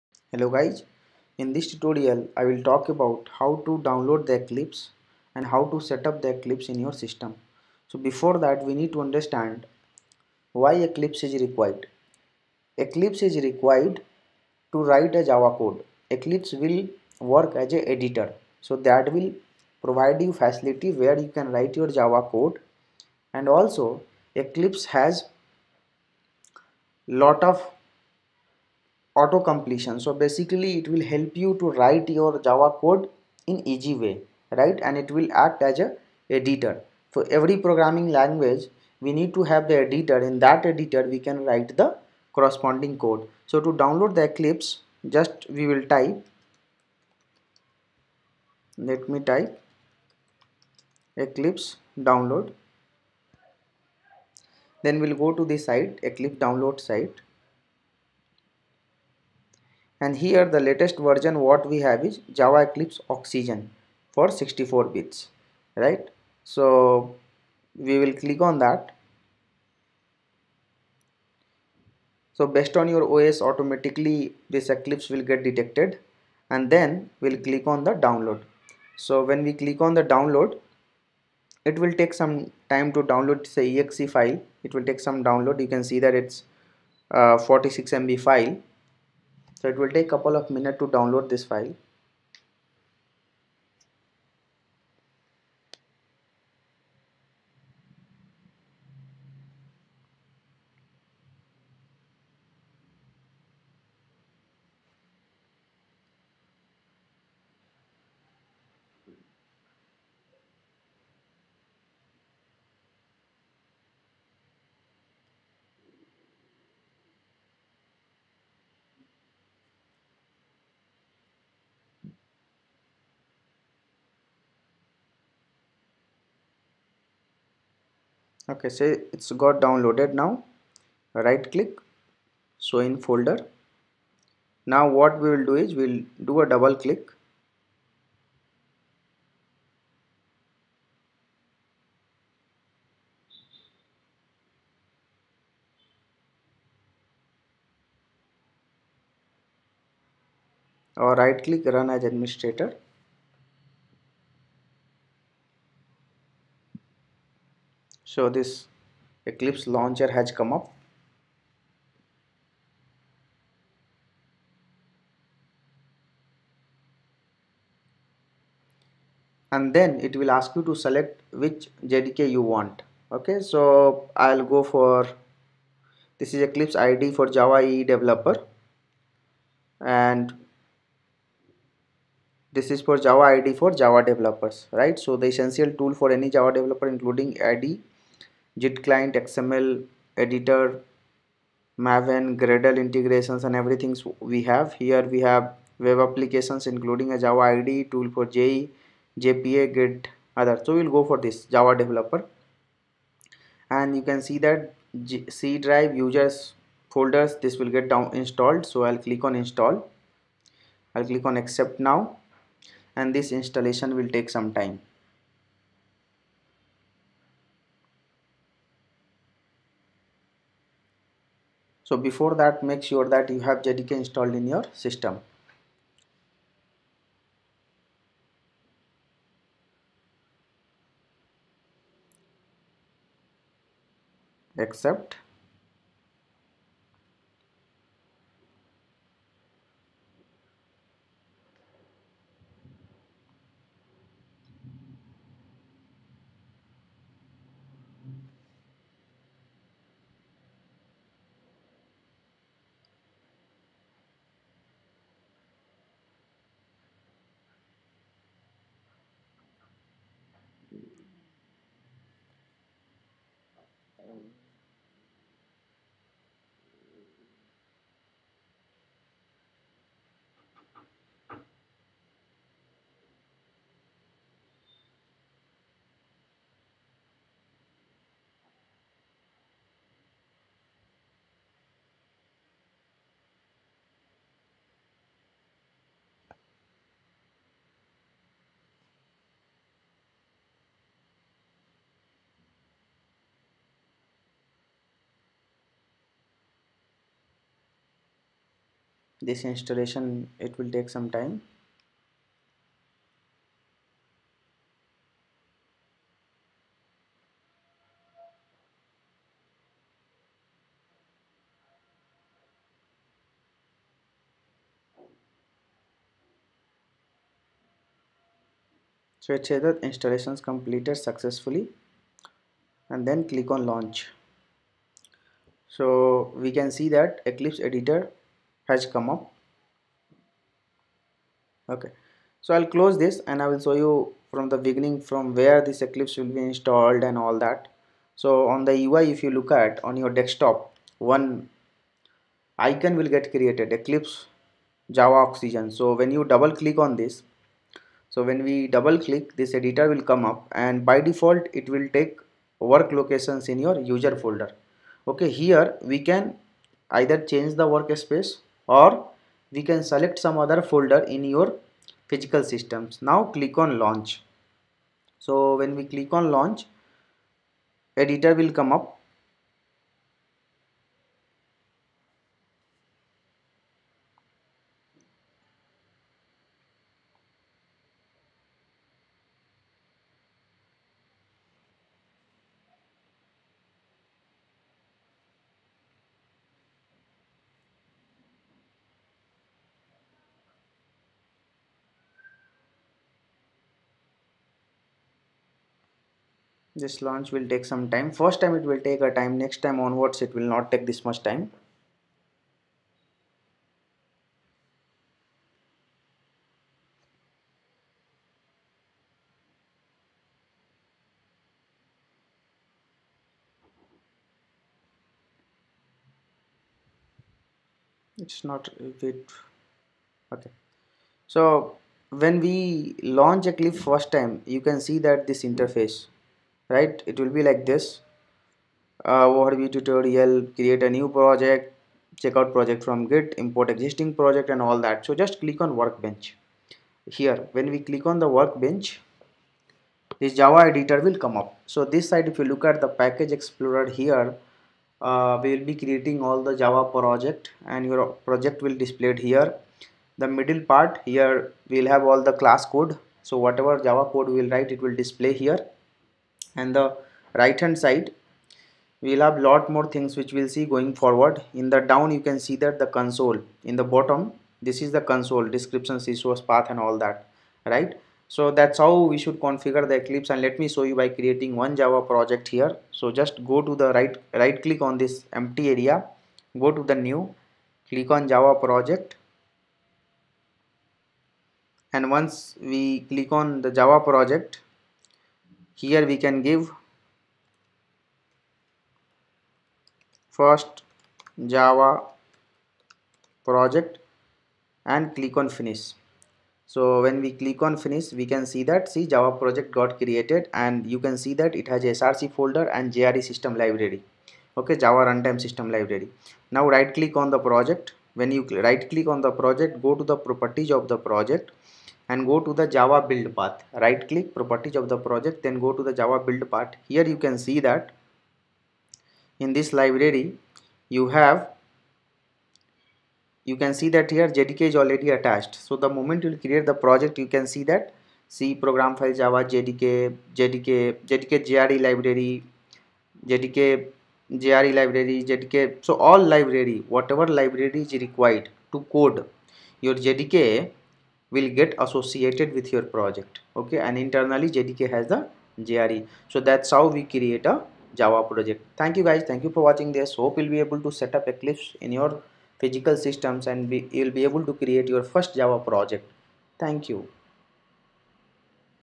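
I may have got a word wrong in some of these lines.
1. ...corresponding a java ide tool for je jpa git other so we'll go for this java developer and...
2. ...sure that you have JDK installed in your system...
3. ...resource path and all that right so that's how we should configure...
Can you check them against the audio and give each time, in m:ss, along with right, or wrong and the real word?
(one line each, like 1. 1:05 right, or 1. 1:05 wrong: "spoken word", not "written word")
1. 3:16 wrong: "including", not "corresponding"
2. 3:42 right
3. 7:46 right.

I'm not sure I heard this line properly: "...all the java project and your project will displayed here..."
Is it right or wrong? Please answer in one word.
right.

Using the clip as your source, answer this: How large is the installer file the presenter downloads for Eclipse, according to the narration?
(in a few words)
46 MB.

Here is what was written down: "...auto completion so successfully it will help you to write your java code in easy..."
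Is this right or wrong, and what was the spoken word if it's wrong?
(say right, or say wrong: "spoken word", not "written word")
wrong: "basically", not "successfully".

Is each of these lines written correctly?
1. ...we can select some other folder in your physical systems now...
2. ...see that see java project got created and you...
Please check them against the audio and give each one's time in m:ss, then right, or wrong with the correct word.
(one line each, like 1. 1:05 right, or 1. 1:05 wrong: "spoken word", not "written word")
1. 5:59 right
2. 8:18 right.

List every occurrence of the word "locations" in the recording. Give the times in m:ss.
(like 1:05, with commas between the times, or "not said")
5:52.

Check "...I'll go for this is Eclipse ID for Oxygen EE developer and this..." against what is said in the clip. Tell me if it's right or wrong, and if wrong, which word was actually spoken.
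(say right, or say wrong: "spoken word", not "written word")
wrong: "Java", not "Oxygen".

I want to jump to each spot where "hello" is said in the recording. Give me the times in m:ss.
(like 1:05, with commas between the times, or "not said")
0:00.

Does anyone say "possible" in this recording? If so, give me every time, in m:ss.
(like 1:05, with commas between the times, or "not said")
not said.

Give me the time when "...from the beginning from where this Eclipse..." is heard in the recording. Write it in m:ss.
5:34.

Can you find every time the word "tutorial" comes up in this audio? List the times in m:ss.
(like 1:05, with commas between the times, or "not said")
0:01, 7:09.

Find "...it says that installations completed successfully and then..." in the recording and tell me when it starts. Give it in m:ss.
5:19.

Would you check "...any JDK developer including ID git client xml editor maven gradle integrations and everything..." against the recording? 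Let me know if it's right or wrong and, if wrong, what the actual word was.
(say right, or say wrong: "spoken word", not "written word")
wrong: "Java", not "JDK".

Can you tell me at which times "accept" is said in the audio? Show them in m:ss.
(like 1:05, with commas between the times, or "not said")
3:31, 3:54.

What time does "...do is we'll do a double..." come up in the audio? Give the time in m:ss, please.
2:15.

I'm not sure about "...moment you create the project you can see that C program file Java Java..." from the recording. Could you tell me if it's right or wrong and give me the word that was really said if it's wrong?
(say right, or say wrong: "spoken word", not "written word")
wrong: "JDK", not "Java".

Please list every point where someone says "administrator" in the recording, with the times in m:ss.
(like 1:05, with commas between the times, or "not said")
2:32.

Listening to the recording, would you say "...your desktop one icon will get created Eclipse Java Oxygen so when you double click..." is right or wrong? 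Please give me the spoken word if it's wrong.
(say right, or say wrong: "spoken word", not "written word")
right.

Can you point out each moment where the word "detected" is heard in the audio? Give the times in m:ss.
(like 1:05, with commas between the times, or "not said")
1:15.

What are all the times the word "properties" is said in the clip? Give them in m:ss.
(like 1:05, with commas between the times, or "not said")
8:30, 8:34.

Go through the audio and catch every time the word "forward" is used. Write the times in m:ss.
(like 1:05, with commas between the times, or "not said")
7:40.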